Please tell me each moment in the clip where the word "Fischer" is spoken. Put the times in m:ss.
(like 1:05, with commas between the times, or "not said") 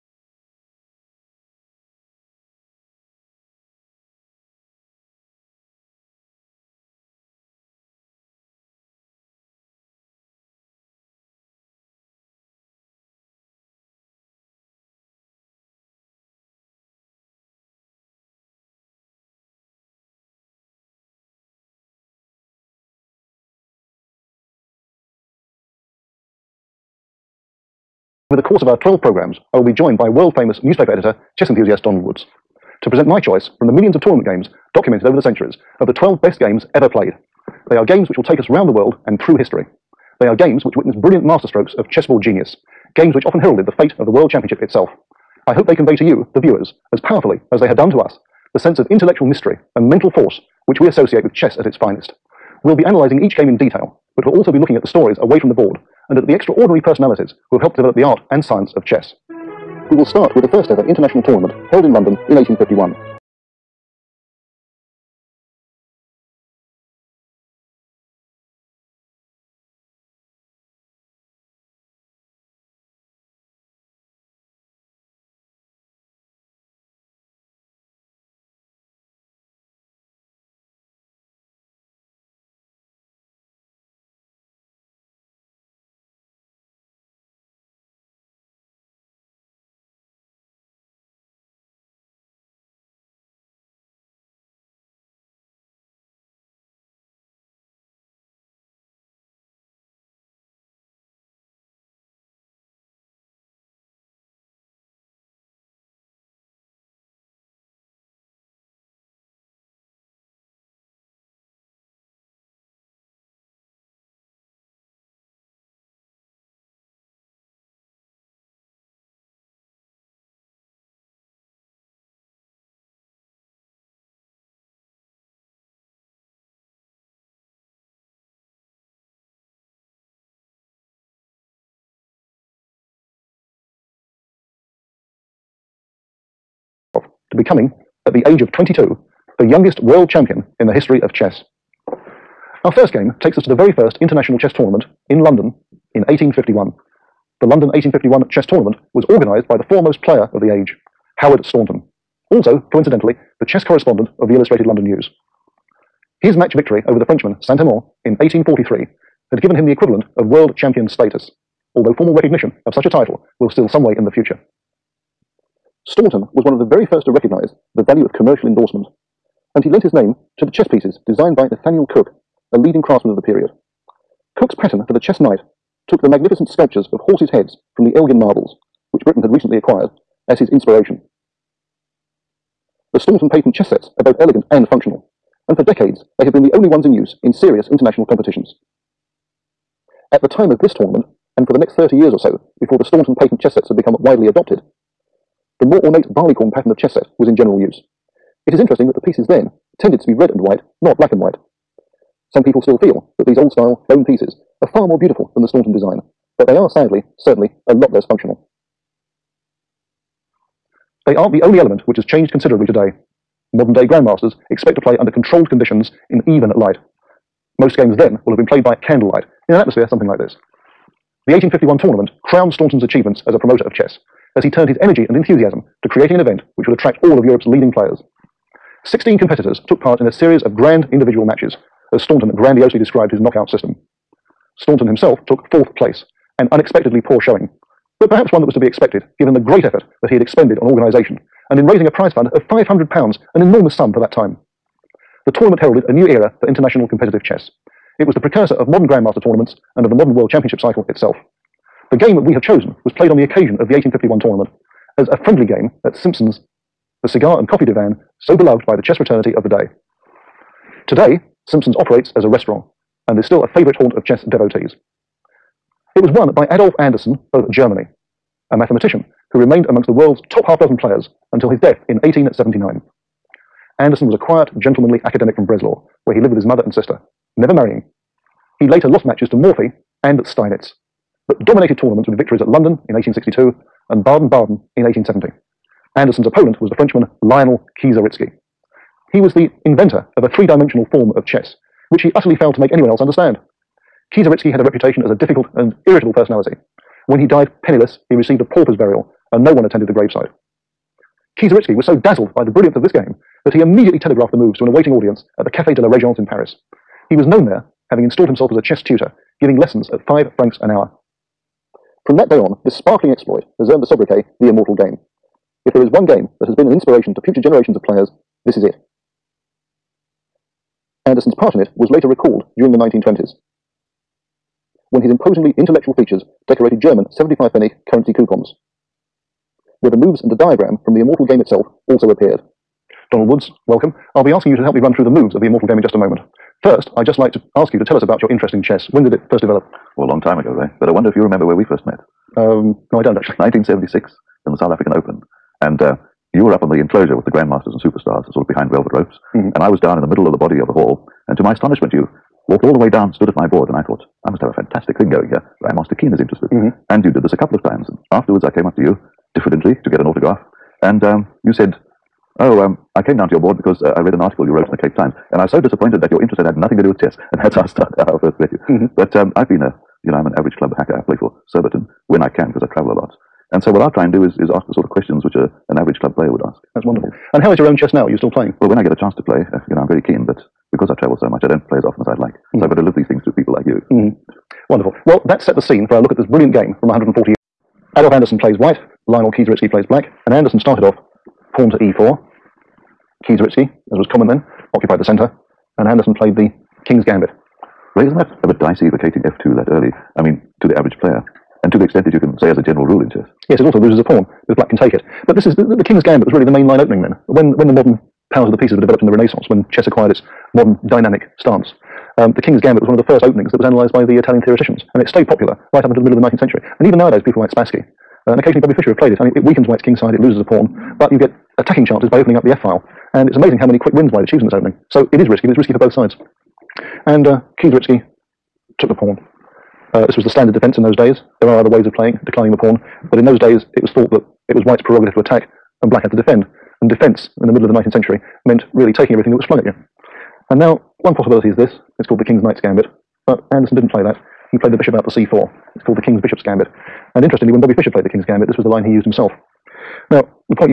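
6:58, 7:27.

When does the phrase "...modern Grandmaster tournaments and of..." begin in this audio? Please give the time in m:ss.
4:08.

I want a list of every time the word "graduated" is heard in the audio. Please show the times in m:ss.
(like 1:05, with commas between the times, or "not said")
not said.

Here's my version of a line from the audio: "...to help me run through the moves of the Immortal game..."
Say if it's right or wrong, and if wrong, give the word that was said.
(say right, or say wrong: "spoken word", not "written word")
right.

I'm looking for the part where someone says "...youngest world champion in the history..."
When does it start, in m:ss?
2:19.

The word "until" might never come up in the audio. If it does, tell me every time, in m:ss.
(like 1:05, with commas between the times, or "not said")
4:31, 6:55.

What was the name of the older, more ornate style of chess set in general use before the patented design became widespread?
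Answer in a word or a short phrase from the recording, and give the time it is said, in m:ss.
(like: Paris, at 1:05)
barleycorn, at 3:16.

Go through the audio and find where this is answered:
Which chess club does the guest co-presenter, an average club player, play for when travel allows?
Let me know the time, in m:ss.
6:11.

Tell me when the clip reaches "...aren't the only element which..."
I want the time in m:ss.
3:31.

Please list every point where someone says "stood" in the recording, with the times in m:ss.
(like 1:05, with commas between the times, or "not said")
5:53.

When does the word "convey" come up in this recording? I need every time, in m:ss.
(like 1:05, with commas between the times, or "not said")
0:45.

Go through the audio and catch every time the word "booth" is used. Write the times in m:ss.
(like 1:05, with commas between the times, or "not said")
not said.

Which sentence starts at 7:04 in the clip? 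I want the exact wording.
So it is risky, but it's risky for both sides.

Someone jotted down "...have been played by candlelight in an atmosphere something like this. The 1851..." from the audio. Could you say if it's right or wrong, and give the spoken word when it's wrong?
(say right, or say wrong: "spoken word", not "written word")
right.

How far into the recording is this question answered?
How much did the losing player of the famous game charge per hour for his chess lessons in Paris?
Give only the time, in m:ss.
5:10.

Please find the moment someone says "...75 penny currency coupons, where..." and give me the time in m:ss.
5:27.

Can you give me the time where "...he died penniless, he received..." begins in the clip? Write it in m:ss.
4:57.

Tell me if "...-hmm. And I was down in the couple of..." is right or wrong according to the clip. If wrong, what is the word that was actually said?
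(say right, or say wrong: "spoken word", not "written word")
wrong: "middle", not "couple".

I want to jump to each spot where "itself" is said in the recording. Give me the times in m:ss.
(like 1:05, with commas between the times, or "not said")
0:44, 4:10, 5:31.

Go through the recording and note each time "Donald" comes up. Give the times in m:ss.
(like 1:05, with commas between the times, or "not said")
0:31, 5:33.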